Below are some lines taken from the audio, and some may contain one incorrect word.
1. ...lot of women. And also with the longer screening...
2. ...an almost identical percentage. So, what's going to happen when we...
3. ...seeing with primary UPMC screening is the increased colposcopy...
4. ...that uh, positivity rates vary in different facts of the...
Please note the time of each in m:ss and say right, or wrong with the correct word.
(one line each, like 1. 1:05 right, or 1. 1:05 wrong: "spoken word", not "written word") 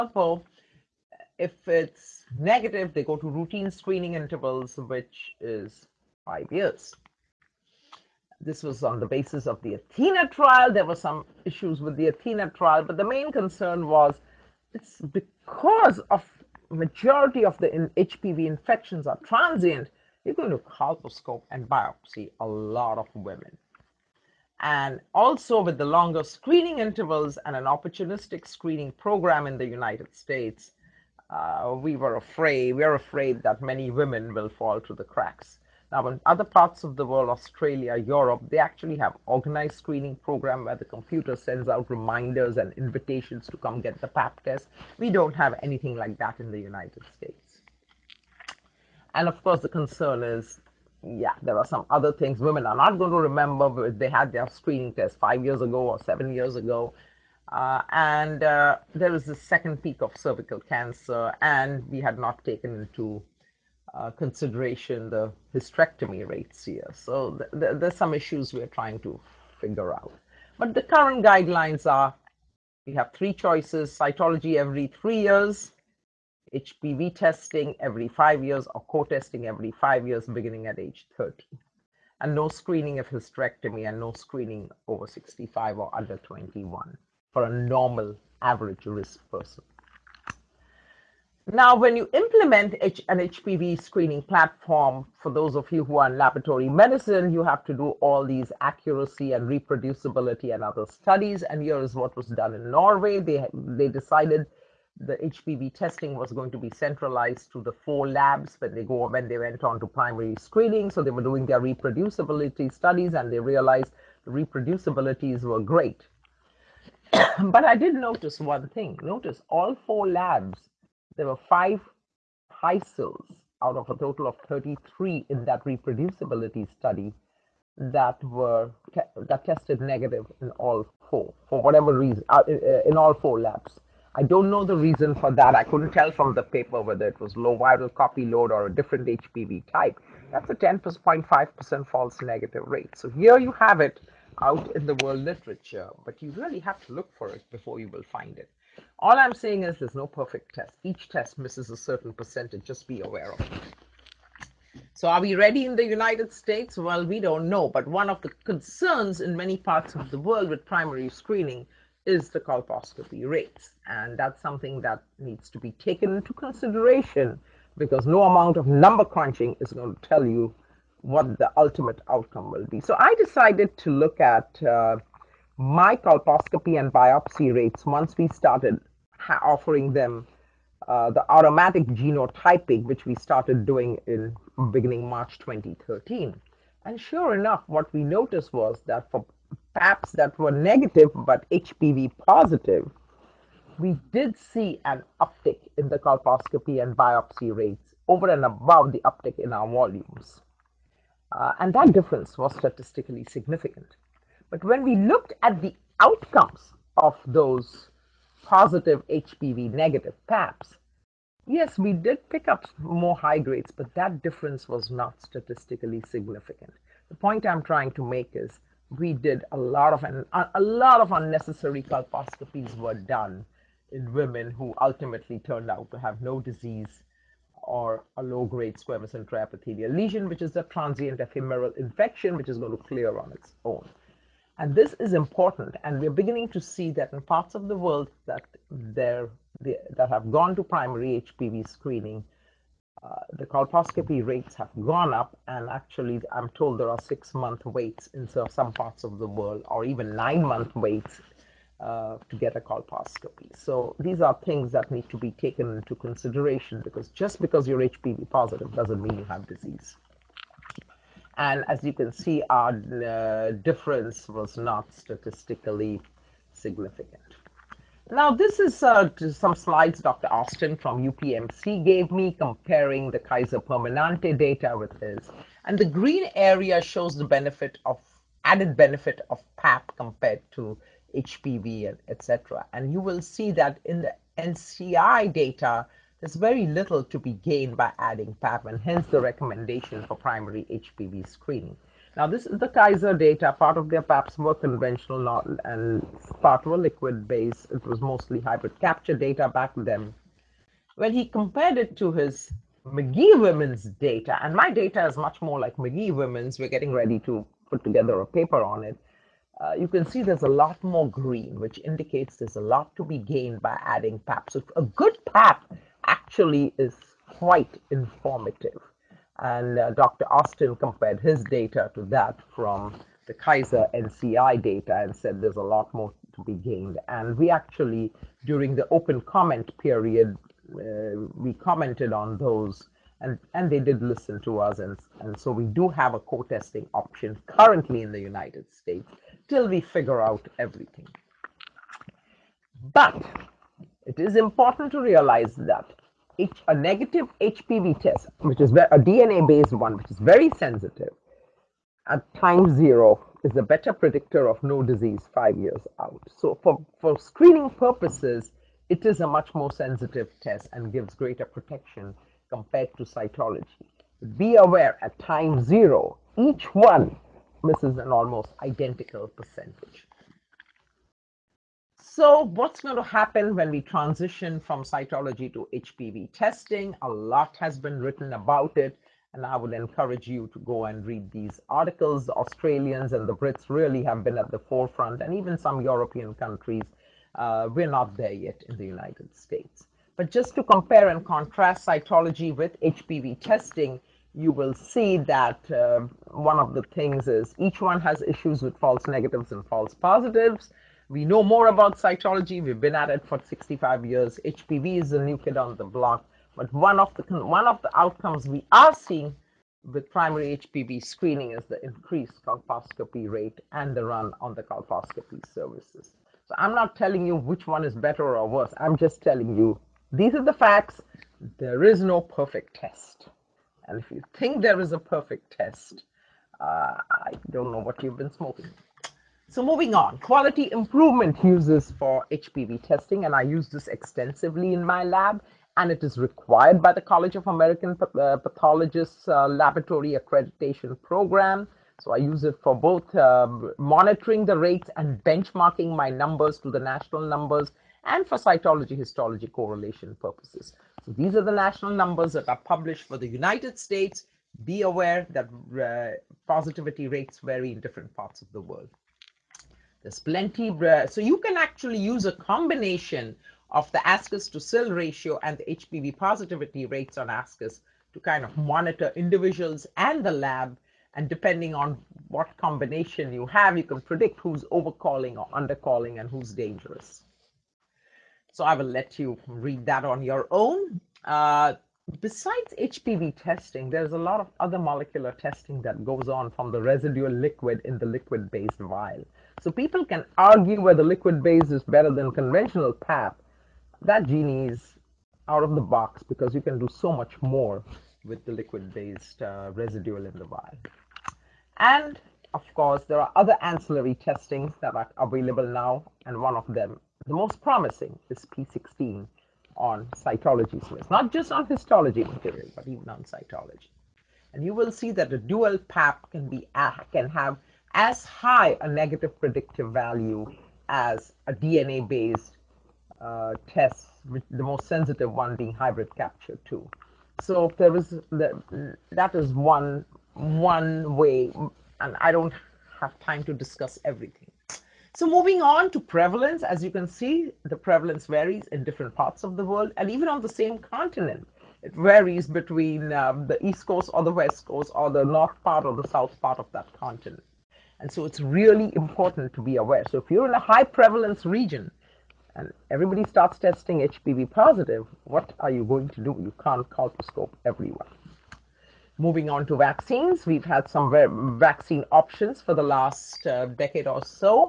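1. 0:22 right
2. 6:07 right
3. 6:48 wrong: "HPV", not "UPMC"
4. 7:35 wrong: "parts", not "facts".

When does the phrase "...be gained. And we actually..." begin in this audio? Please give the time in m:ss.
5:26.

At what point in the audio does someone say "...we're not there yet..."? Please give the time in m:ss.
6:27.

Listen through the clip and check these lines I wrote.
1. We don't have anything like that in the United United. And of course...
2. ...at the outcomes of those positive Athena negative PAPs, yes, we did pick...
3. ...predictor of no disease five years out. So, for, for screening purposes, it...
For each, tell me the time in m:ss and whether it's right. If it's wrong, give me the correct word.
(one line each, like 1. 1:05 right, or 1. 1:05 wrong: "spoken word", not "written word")
1. 0:44 wrong: "States", not "United"
2. 3:25 wrong: "HPV", not "Athena"
3. 5:53 right.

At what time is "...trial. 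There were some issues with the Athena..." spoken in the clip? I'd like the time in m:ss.
0:10.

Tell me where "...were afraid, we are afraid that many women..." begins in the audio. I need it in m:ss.
0:31.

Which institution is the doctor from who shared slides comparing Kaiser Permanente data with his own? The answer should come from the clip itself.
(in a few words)
UPMC.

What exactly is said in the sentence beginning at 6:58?
I'm just telling you these are the facts.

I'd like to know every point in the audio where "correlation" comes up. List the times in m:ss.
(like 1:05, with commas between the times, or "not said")
7:29.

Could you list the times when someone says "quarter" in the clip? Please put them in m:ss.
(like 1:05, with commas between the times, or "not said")
not said.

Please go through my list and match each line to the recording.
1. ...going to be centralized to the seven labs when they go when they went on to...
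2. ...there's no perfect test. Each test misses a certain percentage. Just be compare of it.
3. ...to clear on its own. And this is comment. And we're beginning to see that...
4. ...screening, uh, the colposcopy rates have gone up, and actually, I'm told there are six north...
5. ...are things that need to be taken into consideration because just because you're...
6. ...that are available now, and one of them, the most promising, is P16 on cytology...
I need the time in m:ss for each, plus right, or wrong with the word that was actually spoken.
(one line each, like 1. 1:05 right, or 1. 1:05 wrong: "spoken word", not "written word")
1. 1:46 wrong: "four", not "seven"
2. 2:29 wrong: "aware", not "compare"
3. 3:52 wrong: "important", not "comment"
4. 4:01 wrong: "month", not "north"
5. 4:14 right
6. 8:24 right.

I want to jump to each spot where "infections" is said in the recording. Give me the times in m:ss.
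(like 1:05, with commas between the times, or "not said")
0:18, 3:51.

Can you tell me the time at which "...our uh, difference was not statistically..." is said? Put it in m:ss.
4:22.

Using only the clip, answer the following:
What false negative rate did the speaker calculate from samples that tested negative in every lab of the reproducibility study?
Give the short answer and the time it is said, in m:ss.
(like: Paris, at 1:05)
10.5%, at 2:20.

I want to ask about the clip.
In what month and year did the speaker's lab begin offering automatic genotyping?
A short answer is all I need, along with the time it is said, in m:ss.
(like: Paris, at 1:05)
March 2013, at 3:05.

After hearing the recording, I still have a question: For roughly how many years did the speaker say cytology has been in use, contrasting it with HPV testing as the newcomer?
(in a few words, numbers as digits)
65 years.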